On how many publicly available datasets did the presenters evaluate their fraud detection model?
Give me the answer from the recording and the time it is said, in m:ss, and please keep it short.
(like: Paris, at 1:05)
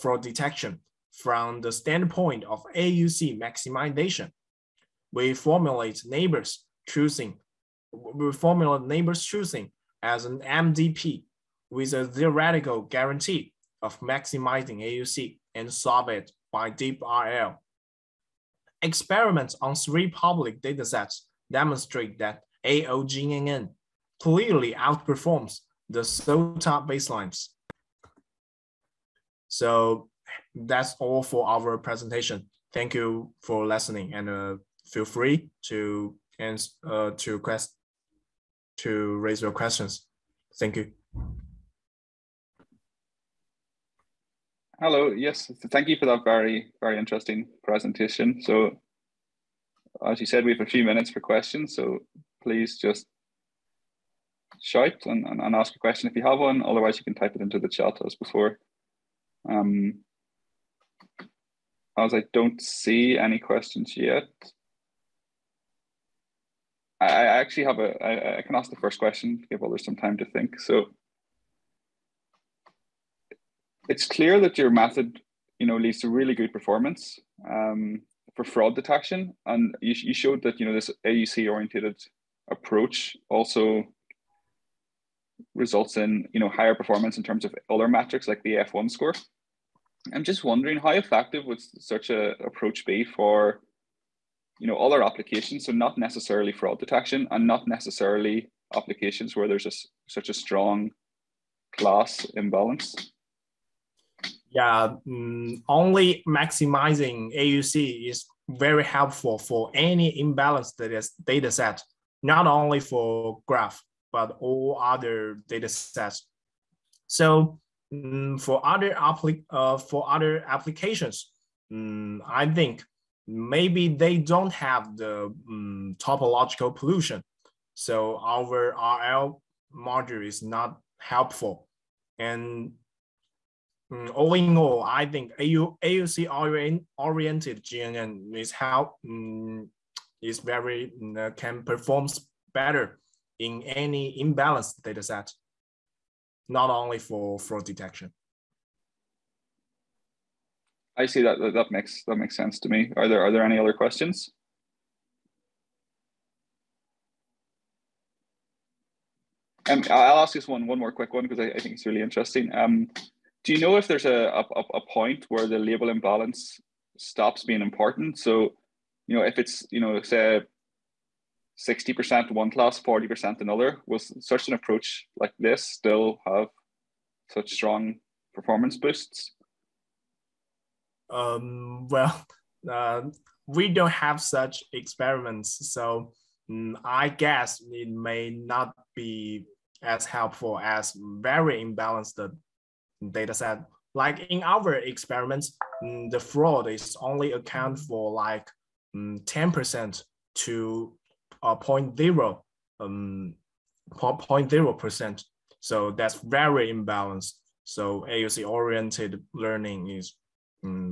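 3, at 0:19.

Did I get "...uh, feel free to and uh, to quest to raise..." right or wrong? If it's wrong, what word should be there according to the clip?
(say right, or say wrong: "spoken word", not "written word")
right.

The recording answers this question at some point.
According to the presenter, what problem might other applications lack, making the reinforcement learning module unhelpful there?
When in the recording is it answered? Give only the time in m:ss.
2:05.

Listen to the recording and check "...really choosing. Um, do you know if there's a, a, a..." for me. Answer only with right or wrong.
wrong.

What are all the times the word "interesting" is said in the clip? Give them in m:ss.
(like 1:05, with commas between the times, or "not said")
0:46, 2:42.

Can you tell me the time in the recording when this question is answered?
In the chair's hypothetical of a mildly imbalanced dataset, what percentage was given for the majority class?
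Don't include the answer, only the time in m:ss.
2:51.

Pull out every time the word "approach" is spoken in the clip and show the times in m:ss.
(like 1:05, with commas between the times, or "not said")
1:22, 1:32, 2:54.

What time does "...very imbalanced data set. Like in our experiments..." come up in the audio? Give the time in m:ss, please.
3:10.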